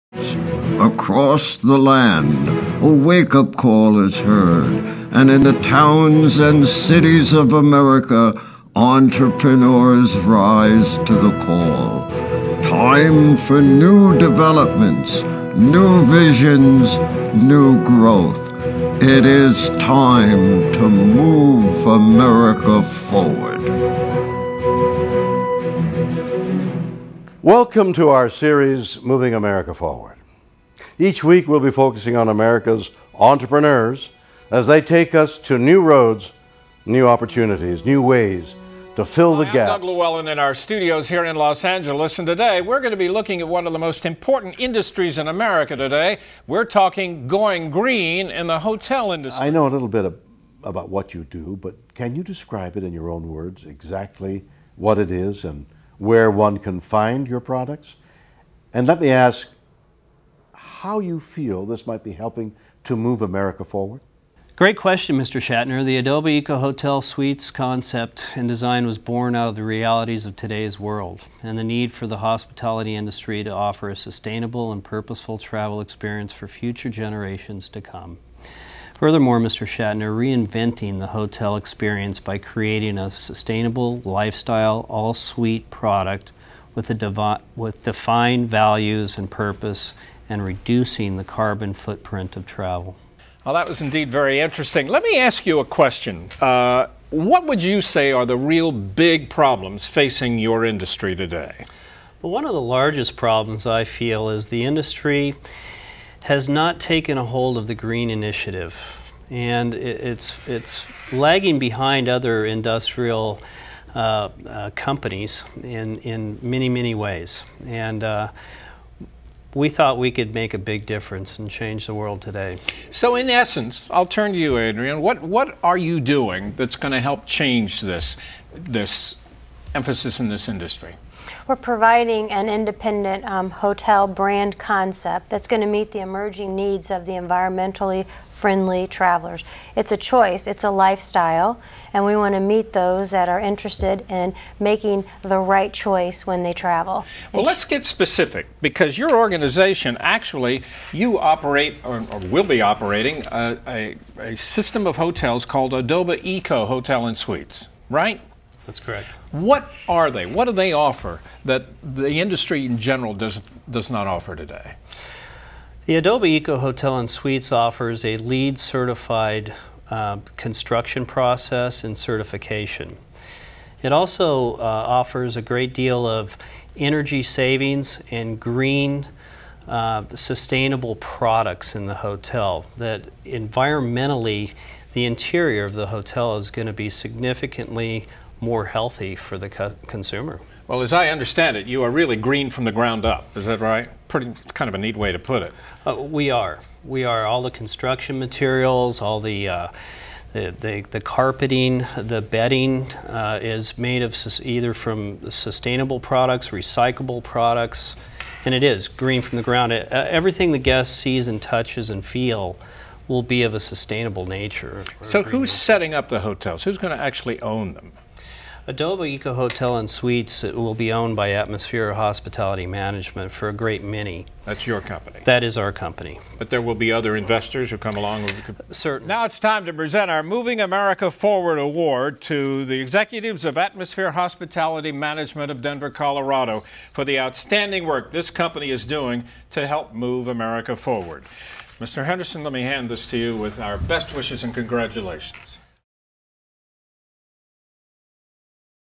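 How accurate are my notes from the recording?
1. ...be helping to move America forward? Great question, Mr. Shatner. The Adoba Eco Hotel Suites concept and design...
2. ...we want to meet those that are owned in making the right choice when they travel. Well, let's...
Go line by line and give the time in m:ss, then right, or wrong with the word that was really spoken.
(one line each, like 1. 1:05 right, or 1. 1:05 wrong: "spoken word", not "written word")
1. 1:02 right
2. 2:22 wrong: "interested", not "owned".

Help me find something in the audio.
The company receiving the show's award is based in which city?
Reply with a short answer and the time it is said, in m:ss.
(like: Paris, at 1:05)
Denver, Colorado, at 3:55.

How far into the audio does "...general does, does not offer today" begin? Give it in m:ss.
2:42.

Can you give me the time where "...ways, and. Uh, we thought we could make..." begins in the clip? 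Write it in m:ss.
1:56.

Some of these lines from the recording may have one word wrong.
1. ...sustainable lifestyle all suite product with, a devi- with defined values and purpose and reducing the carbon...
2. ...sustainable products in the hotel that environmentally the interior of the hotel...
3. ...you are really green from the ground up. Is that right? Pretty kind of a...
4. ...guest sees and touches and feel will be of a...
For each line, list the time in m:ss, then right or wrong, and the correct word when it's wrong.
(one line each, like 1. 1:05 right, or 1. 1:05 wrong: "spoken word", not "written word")
1. 1:23 right
2. 3:00 right
3. 3:11 right
4. 3:30 right.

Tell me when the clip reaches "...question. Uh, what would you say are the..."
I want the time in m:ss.
1:35.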